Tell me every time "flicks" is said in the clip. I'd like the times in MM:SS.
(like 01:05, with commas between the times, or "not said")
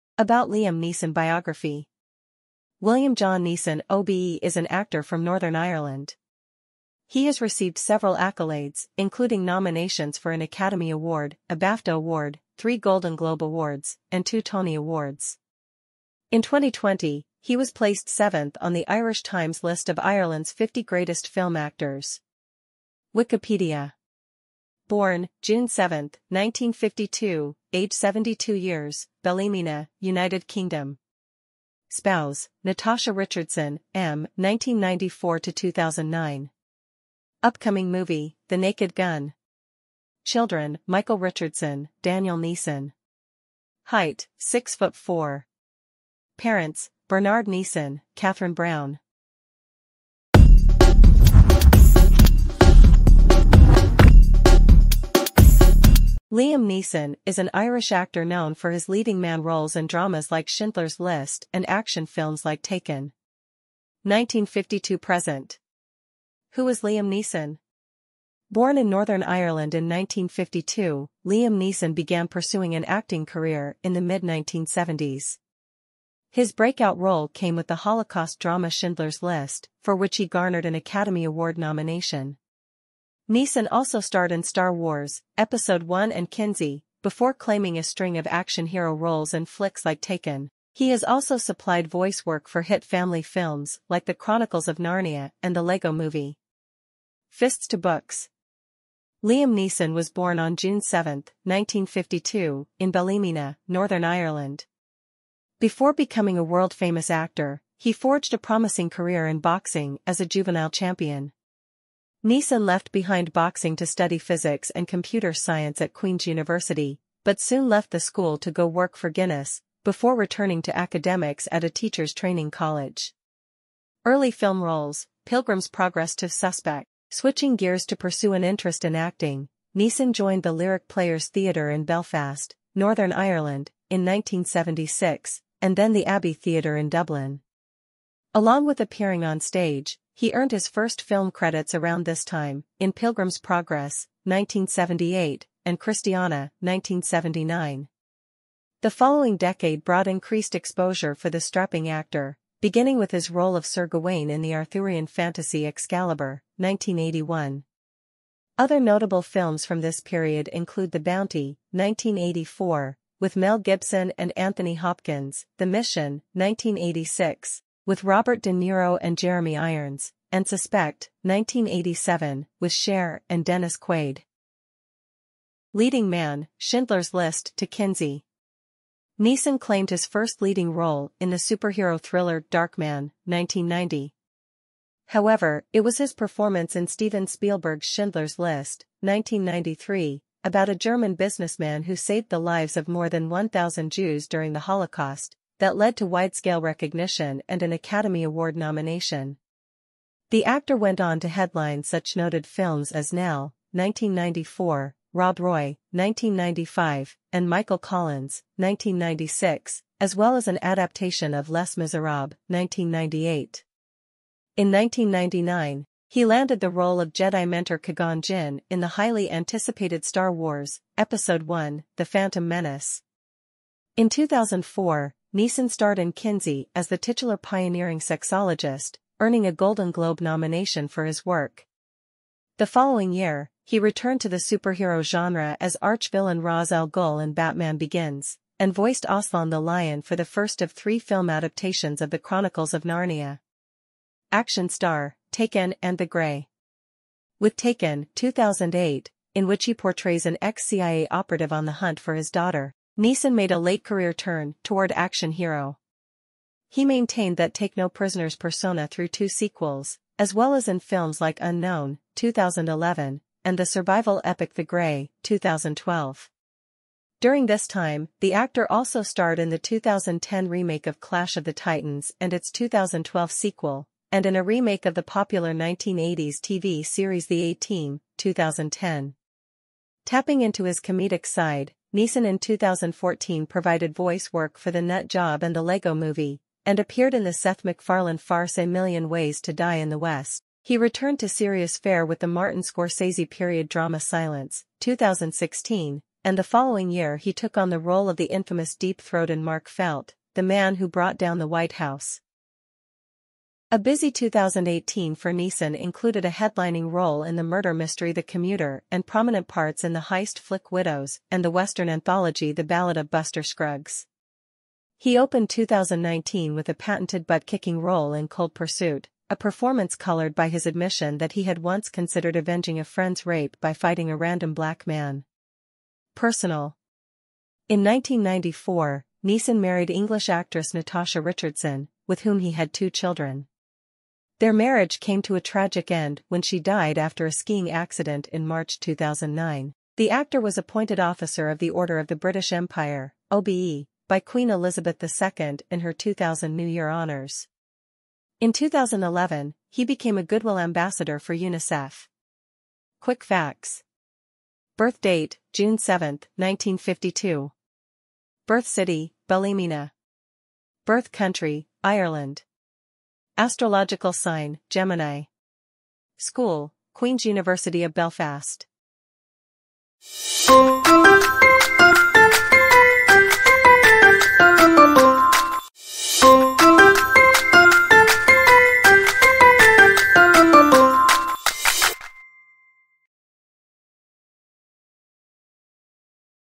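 01:29, 05:10.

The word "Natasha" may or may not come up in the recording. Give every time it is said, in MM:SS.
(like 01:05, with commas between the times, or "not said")
00:32, 05:30.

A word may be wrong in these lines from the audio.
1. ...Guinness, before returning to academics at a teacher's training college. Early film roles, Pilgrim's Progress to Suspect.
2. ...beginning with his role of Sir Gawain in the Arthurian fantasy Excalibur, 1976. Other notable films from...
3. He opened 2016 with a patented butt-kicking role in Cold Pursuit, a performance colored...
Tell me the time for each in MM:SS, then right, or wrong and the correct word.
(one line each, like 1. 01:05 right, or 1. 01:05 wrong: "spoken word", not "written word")
1. 01:59 right
2. 02:32 wrong: "1981", not "1976"
3. 05:14 wrong: "2019", not "2016".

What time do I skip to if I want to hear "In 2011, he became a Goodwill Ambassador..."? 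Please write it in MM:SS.
05:48.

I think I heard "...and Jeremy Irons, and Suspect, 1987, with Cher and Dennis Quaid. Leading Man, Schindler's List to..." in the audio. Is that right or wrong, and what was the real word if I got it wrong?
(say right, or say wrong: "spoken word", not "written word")
right.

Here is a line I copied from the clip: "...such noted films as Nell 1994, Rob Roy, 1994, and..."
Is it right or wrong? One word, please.
wrong.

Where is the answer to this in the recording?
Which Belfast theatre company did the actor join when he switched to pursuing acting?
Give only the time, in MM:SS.
02:10.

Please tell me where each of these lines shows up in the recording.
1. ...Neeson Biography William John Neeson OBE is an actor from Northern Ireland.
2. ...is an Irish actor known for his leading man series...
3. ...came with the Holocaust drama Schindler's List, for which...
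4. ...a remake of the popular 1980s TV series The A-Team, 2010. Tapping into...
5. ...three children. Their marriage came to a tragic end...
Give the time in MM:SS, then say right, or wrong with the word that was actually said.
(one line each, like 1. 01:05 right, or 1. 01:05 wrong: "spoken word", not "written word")
1. 00:00 right
2. 00:57 wrong: "roles", not "series"
3. 01:17 right
4. 04:34 right
5. 05:32 wrong: "two", not "three".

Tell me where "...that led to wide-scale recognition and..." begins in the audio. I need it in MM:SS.
03:15.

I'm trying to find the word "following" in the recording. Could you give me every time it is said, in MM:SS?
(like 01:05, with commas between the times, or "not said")
02:28, 03:52, 04:56.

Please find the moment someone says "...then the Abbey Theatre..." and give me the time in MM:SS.
02:15.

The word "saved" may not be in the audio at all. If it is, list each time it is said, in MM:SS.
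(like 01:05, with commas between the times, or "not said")
03:11.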